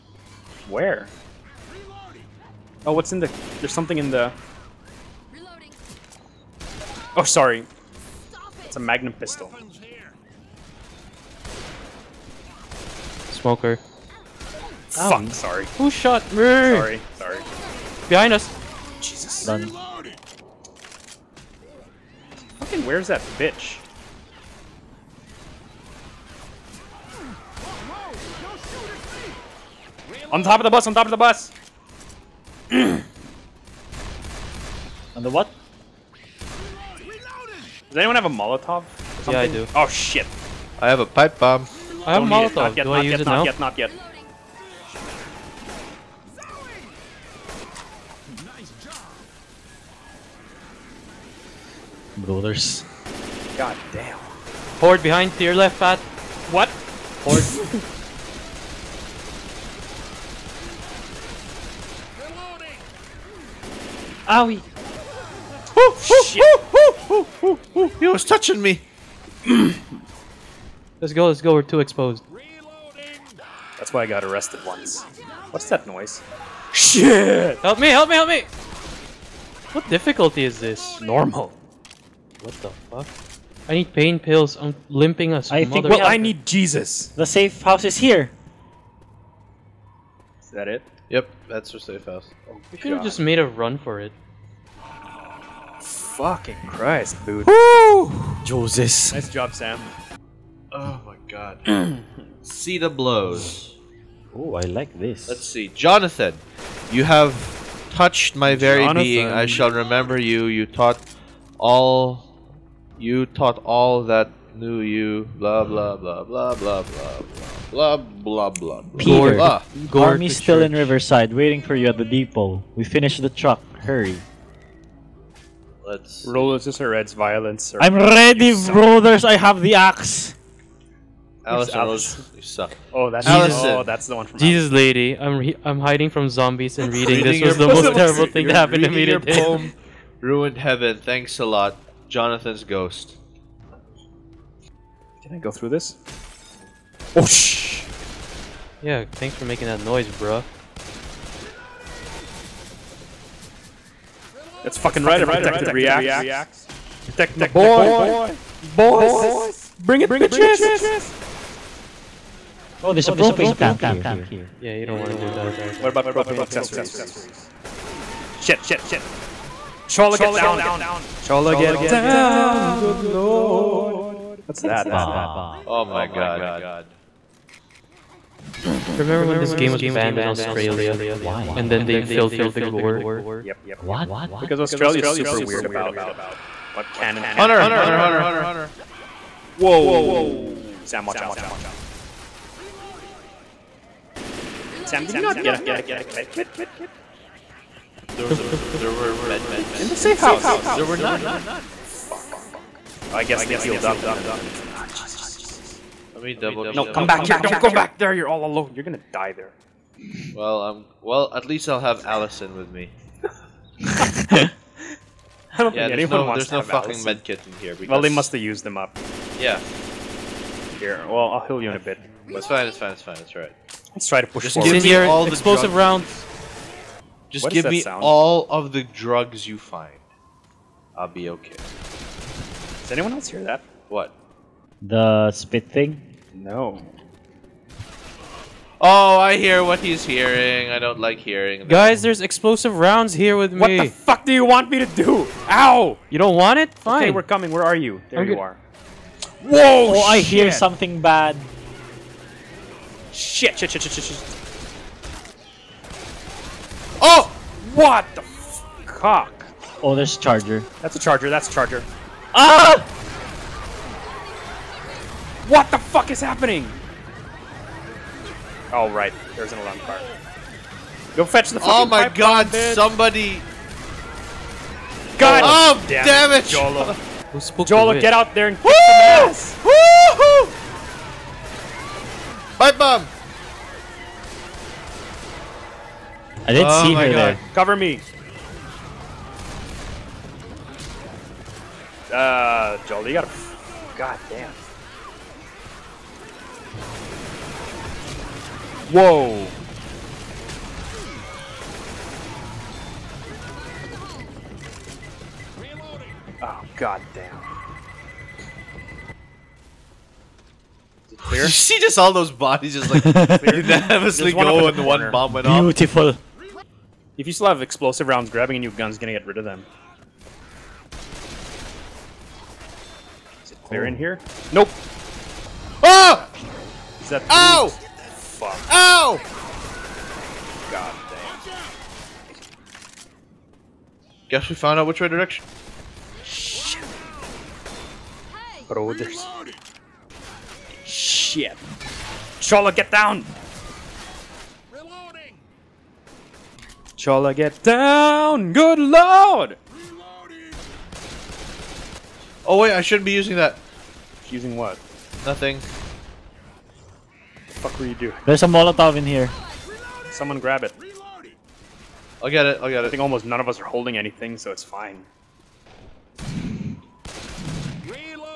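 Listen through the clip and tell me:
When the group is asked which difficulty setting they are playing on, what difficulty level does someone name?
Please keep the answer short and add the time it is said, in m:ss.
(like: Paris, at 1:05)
Normal, at 1:20.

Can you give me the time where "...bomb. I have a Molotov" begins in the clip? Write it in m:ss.
0:41.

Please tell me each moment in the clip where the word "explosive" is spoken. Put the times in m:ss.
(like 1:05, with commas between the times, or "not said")
3:45, 4:02, 5:17.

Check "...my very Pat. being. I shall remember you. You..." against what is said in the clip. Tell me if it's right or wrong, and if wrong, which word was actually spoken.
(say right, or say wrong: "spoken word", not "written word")
wrong: "Jonathan", not "Pat".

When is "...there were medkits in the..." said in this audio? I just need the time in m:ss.
3:18.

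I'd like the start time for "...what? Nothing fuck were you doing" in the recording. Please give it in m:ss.
5:54.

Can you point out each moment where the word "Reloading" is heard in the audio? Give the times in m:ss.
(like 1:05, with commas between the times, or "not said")
0:05, 5:44, 5:49.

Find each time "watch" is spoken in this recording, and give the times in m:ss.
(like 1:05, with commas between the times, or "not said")
3:11.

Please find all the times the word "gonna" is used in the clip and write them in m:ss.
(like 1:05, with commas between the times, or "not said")
3:28, 5:18.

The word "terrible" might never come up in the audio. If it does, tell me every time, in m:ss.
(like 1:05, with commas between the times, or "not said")
2:17.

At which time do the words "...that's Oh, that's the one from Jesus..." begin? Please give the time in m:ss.
2:13.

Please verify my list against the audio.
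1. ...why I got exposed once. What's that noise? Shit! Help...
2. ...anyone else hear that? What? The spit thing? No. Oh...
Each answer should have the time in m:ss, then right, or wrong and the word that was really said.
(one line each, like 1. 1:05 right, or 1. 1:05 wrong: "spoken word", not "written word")
1. 1:13 wrong: "arrested", not "exposed"
2. 3:52 right.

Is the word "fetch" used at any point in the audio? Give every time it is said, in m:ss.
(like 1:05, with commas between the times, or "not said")
4:31.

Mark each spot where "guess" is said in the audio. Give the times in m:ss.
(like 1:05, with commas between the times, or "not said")
3:23, 5:34.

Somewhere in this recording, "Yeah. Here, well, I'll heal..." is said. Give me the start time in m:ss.
3:39.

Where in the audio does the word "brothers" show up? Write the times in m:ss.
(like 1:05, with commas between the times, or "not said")
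0:52, 2:08.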